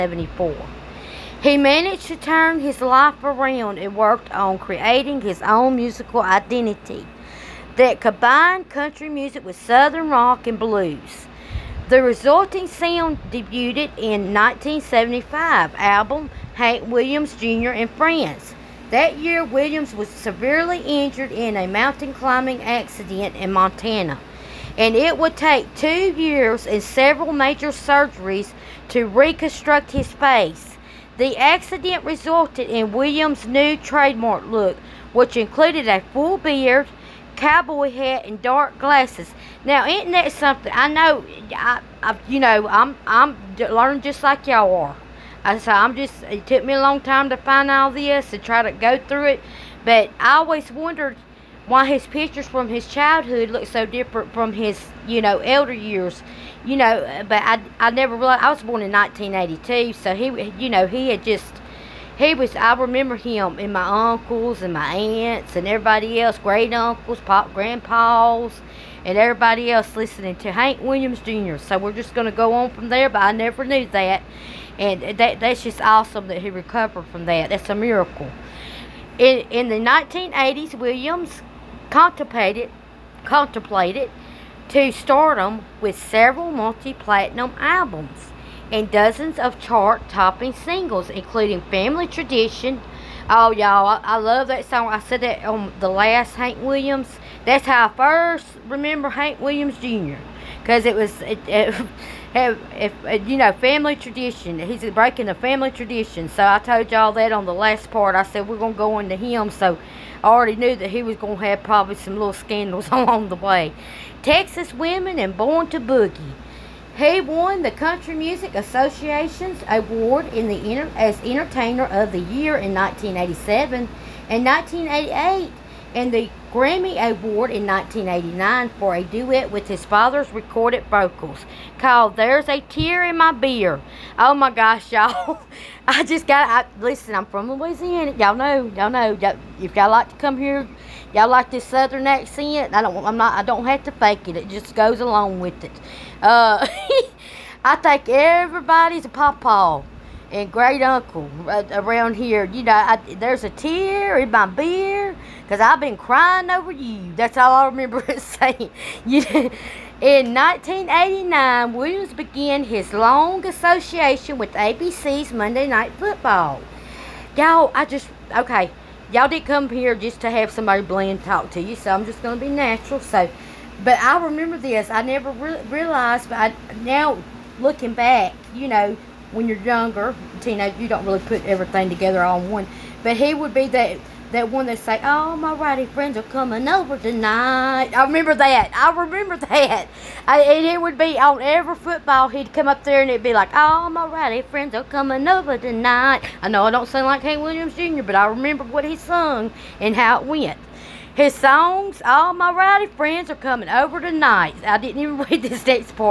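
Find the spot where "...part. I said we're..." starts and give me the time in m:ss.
1:47.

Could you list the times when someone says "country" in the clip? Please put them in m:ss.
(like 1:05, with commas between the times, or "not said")
0:08, 1:57.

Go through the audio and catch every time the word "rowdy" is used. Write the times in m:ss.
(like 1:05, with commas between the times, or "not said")
3:05, 3:14, 3:22.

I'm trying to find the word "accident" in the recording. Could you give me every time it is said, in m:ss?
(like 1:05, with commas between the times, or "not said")
0:22, 0:31.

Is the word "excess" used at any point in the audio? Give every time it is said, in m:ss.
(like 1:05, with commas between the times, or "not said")
not said.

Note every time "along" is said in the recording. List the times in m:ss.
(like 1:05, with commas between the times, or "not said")
1:52, 2:25.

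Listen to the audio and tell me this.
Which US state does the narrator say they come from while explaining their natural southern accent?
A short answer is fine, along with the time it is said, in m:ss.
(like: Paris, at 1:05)
Louisiana, at 2:17.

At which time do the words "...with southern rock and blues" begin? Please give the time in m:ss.
0:09.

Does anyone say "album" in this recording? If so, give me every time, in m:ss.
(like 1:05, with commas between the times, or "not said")
0:15, 1:27.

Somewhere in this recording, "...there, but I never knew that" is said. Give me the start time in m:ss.
1:12.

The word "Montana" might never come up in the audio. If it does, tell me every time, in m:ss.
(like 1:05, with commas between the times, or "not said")
0:23.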